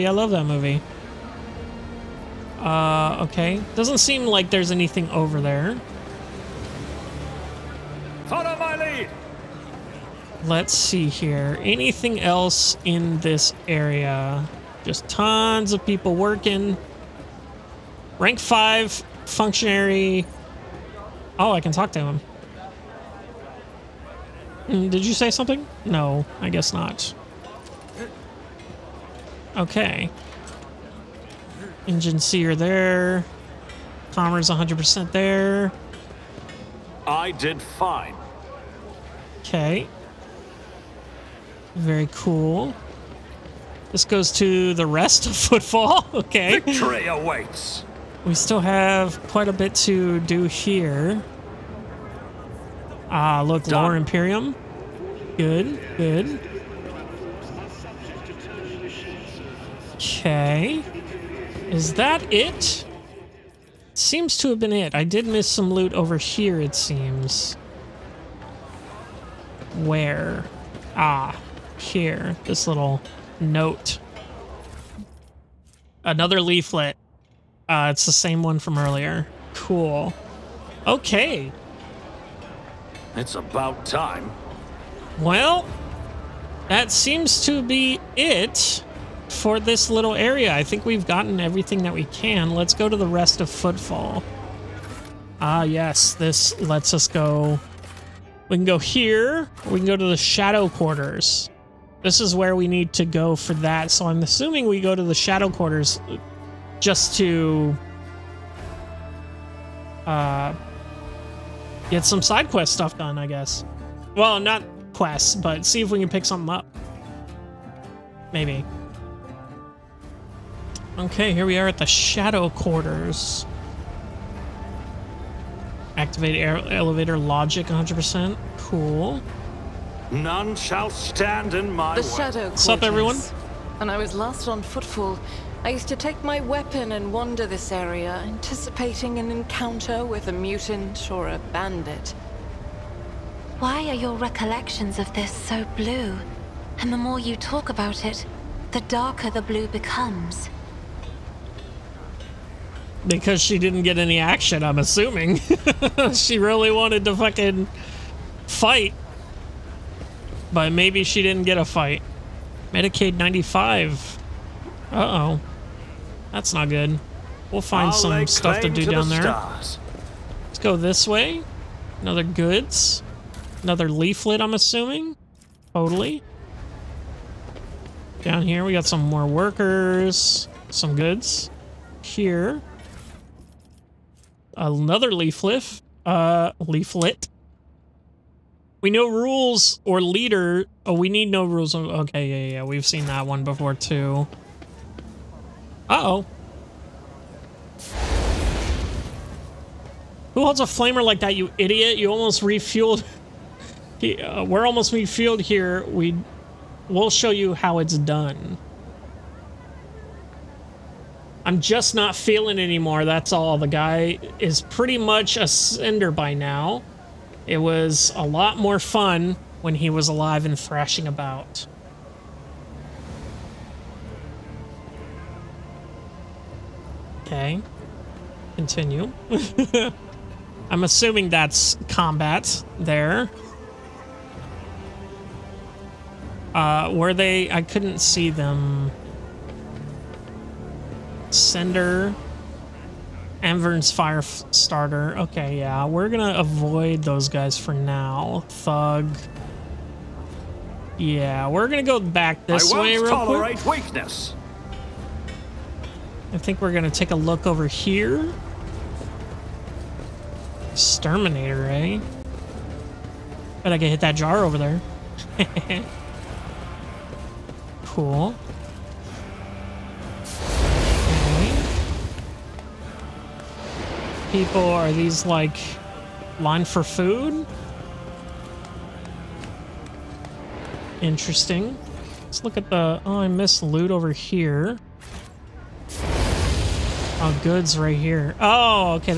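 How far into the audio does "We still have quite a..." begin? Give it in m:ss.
0:48.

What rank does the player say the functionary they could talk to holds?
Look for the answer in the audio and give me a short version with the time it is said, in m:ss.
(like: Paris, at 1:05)
Rank 5, at 0:18.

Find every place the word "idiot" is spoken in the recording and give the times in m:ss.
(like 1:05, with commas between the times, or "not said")
3:21.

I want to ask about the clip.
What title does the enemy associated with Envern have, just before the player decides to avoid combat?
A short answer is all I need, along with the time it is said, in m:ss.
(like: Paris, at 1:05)
fire starter, at 4:03.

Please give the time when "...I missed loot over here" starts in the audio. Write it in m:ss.
4:43.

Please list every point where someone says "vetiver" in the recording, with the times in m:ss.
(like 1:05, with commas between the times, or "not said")
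not said.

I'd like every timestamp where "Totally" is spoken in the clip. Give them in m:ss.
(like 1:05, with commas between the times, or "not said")
2:55.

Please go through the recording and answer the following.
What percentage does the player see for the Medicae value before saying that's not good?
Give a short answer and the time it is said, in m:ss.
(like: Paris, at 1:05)
95, at 2:42.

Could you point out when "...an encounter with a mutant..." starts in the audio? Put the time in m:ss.
2:19.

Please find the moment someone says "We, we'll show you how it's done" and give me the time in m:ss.
3:25.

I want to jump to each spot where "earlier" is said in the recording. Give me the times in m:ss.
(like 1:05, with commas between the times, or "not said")
1:18.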